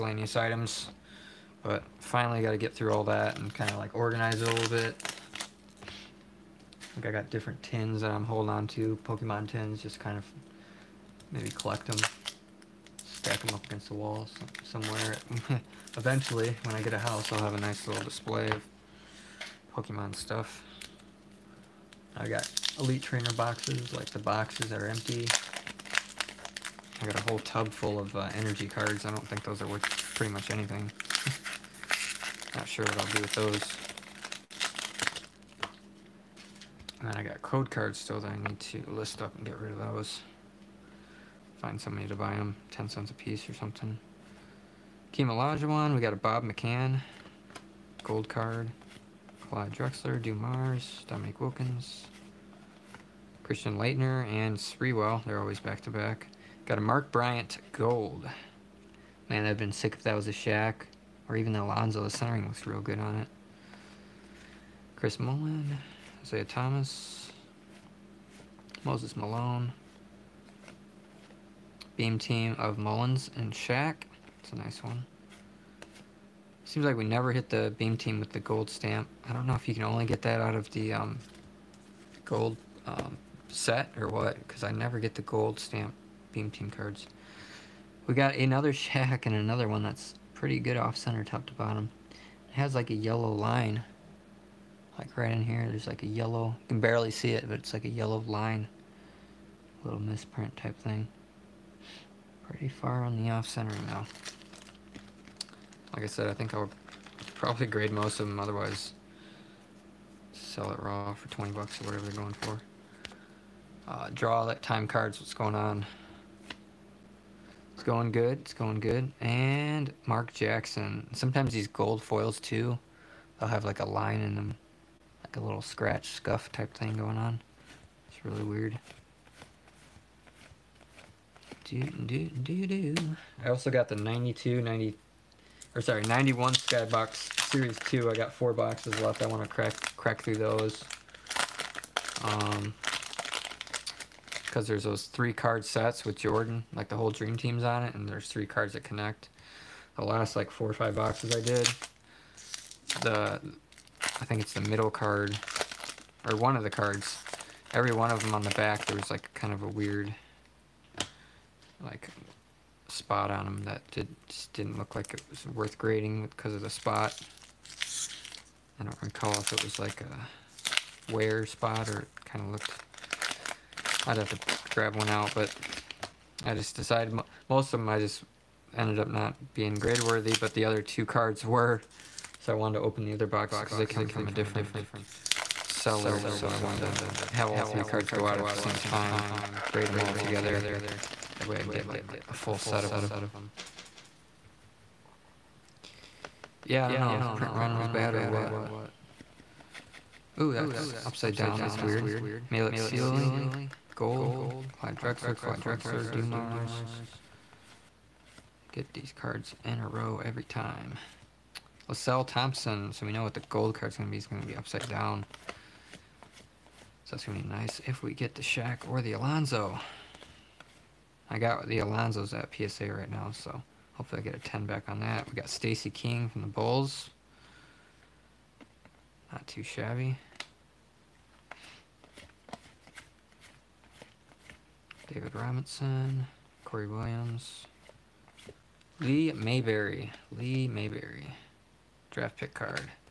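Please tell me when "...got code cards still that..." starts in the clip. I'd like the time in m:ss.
0:37.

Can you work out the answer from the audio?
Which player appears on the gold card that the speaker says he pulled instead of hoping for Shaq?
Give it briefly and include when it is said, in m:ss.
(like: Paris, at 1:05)
Mark Bryant, at 0:56.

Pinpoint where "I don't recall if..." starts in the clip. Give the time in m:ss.
2:48.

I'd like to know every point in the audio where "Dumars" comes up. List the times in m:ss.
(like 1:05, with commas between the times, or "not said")
0:50, 3:26.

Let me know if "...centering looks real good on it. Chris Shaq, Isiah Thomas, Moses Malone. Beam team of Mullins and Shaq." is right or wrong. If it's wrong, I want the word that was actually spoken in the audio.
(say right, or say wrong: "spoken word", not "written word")
wrong: "Mullin", not "Shaq".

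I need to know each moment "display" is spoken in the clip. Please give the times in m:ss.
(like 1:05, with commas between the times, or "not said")
0:18.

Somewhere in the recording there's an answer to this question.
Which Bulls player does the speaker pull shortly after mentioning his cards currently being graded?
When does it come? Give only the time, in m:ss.
3:45.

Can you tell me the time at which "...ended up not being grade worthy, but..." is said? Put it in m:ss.
2:58.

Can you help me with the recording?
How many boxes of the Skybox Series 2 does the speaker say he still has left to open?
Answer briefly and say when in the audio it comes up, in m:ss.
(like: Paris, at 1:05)
4, at 2:18.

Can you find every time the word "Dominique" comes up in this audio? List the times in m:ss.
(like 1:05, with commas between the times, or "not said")
0:51.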